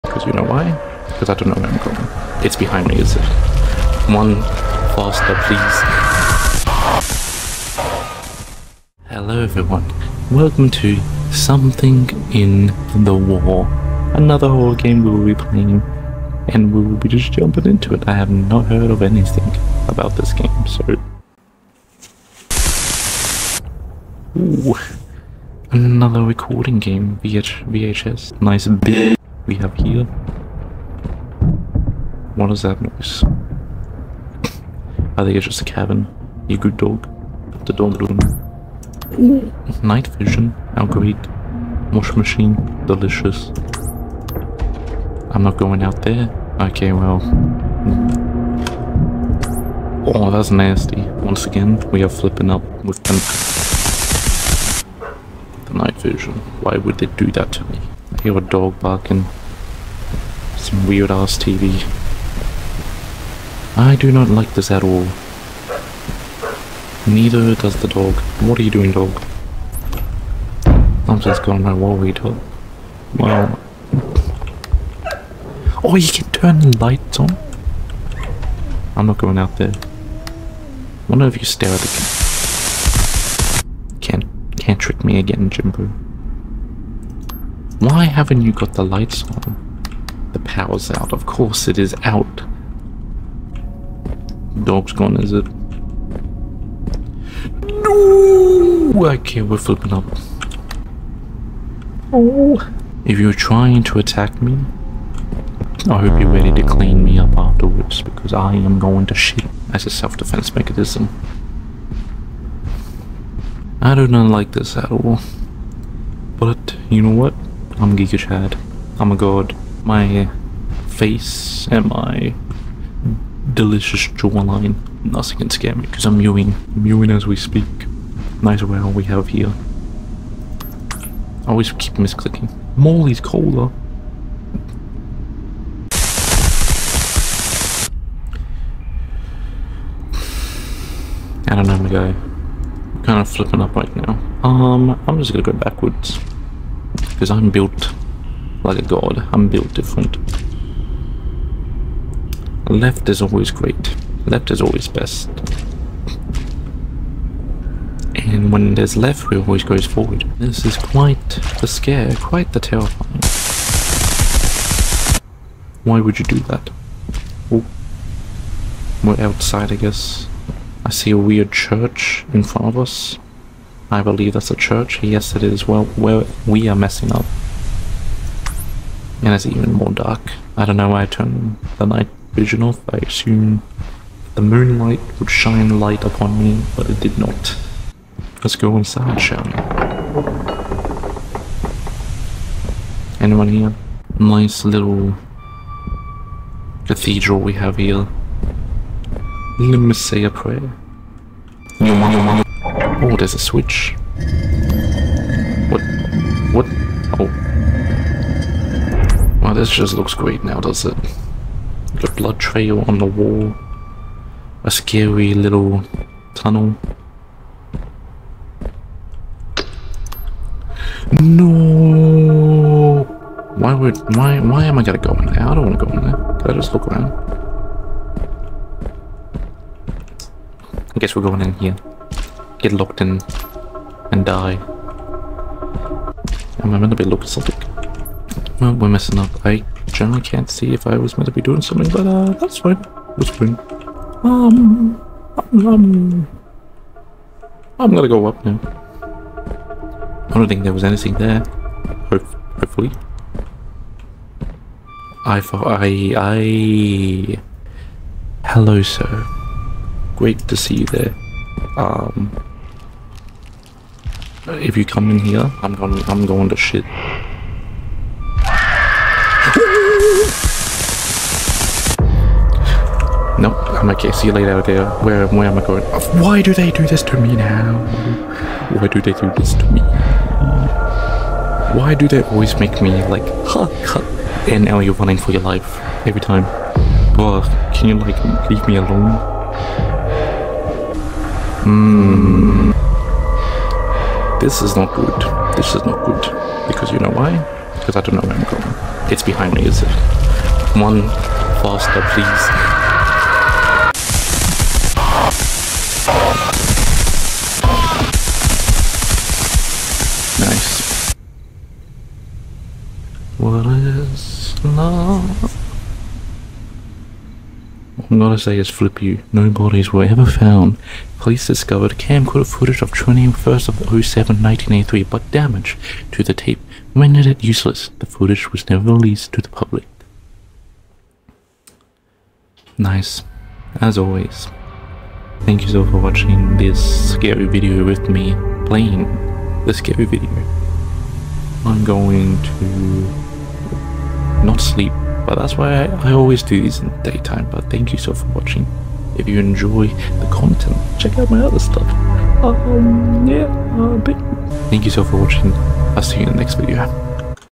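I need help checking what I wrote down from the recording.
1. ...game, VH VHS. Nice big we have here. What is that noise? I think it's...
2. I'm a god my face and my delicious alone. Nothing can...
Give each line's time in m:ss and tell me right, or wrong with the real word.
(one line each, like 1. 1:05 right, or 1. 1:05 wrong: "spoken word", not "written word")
1. 0:26 right
2. 1:58 wrong: "jawline", not "alone".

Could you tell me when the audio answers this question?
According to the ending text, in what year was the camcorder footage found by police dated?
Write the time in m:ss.
5:24.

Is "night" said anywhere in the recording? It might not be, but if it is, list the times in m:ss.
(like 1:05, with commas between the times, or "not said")
0:39, 0:55, 3:01.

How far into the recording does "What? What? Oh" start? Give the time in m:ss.
3:25.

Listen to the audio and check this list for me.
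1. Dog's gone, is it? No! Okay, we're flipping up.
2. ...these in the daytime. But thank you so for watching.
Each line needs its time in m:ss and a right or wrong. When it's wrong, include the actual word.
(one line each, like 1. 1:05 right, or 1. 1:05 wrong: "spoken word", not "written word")
1. 1:34 right
2. 5:46 right.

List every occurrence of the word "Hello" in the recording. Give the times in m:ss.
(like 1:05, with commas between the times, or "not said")
0:09, 4:18.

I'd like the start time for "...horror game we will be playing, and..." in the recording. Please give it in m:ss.
0:14.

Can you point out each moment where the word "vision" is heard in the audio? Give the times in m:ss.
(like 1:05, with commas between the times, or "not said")
0:40, 0:56, 3:02.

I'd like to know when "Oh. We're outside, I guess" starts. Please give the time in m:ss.
2:47.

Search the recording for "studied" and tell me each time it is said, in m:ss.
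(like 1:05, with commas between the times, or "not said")
not said.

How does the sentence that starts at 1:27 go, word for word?
Why haven't you got the lights on?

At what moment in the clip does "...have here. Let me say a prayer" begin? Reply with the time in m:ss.
3:17.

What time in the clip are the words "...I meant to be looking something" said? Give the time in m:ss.
3:56.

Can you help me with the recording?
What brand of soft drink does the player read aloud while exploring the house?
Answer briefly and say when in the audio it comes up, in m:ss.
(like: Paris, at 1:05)
Molly's cola, at 2:12.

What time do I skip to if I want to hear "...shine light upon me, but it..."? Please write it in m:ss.
3:05.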